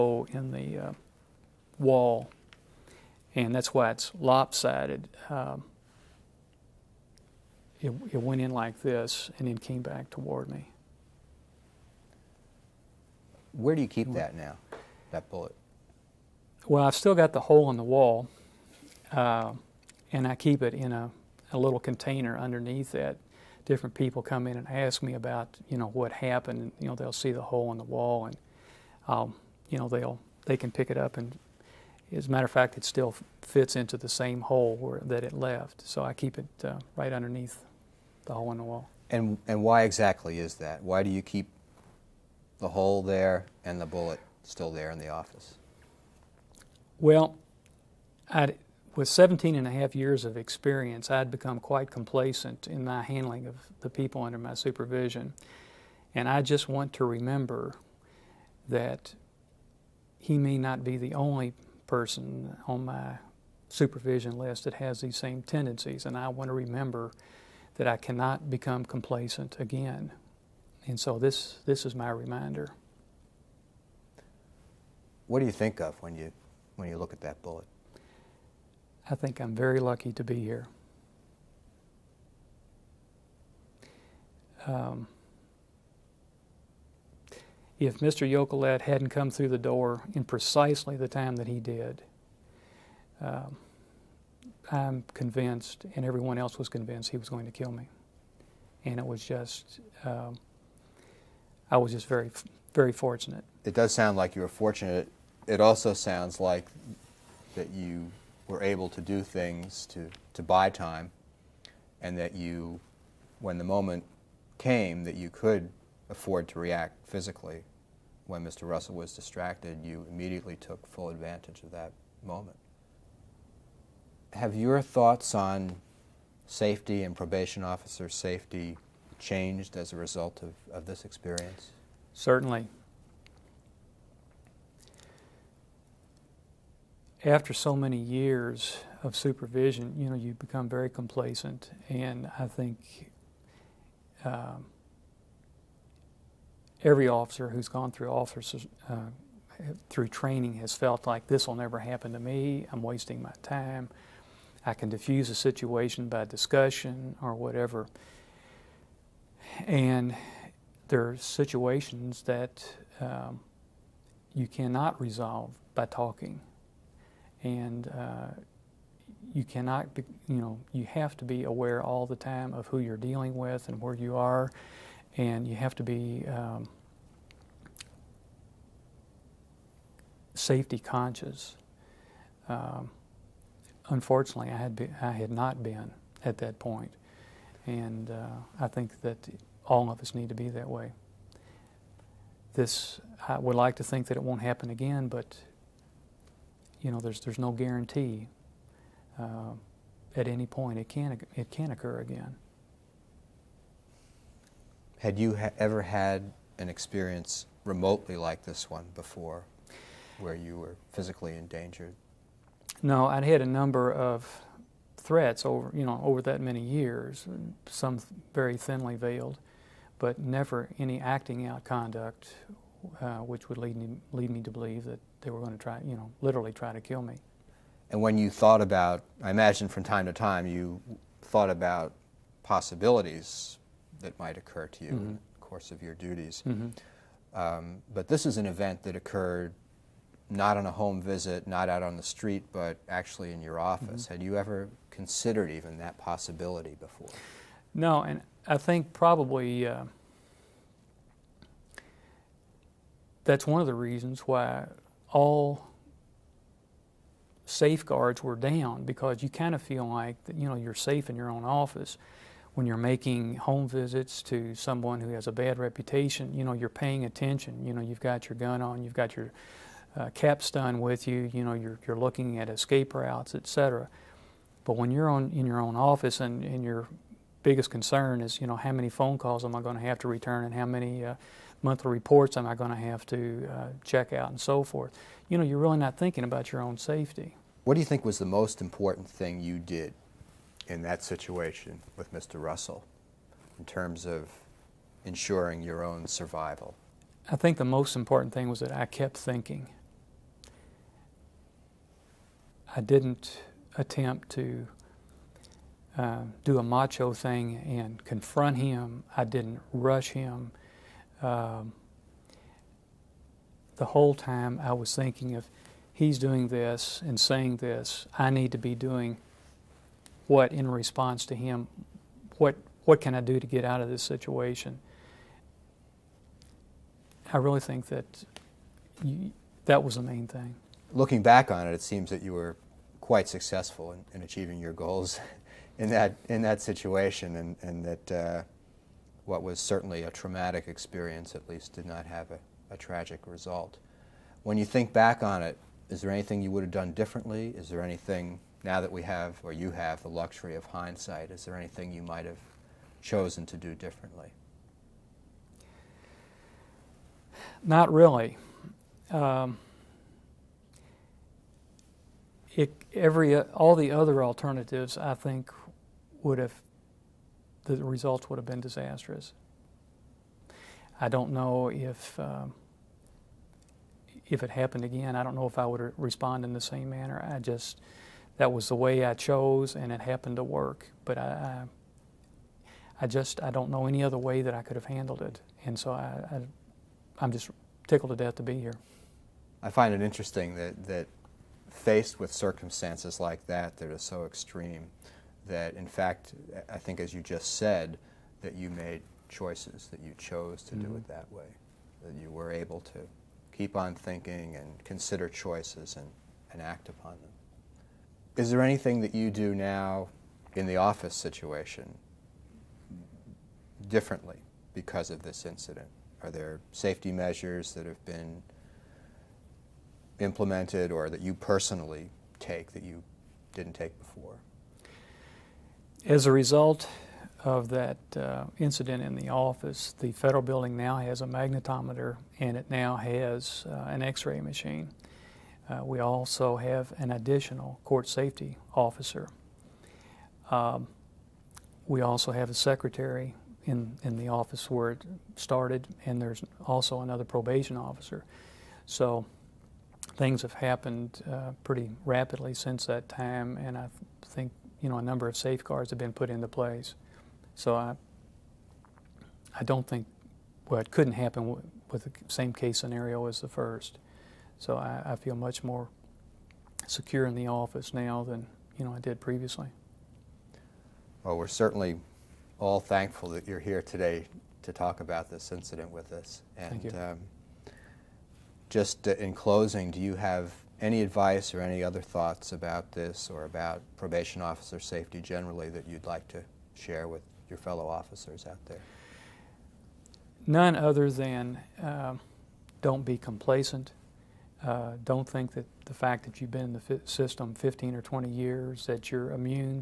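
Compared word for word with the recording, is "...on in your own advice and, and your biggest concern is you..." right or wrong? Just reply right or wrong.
wrong.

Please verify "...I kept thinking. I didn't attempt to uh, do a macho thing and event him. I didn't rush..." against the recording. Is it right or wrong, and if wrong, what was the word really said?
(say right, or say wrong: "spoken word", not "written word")
wrong: "confront", not "event".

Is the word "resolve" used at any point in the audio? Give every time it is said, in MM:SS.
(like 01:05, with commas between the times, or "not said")
02:44.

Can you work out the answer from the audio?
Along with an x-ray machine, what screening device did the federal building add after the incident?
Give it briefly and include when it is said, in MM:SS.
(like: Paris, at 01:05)
Magnetometer, at 07:11.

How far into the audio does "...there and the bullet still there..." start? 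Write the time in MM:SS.
00:43.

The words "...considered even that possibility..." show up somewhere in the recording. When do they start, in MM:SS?
04:04.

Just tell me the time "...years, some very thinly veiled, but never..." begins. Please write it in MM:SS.
03:36.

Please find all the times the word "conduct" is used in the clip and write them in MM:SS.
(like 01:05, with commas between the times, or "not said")
03:41.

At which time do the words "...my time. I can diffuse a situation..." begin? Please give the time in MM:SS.
02:33.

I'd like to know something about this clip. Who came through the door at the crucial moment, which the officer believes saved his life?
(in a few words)
Mr. Yokolet.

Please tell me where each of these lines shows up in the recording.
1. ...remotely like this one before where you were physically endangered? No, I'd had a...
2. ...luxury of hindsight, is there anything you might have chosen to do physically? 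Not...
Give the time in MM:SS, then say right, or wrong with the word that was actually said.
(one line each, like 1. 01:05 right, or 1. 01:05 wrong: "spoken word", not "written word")
1. 03:27 right
2. 05:50 wrong: "differently", not "physically".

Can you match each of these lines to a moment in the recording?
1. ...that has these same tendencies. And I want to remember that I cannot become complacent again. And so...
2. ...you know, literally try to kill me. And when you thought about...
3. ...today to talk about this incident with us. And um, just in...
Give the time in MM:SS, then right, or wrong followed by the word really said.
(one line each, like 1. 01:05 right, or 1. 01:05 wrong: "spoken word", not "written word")
1. 01:04 right
2. 03:45 right
3. 07:53 right.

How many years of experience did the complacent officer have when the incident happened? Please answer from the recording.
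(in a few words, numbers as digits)
17.5.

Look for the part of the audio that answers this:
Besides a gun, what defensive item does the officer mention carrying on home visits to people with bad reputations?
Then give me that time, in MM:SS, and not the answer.
04:30.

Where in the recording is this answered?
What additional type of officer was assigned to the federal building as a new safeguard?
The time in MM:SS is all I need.
07:17.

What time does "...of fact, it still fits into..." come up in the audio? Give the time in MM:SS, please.
00:32.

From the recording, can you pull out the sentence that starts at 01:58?
Russell was distracted, you immediately took full advantage of that moment.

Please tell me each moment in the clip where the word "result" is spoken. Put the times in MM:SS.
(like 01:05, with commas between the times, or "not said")
02:09, 05:43, 06:07, 07:06.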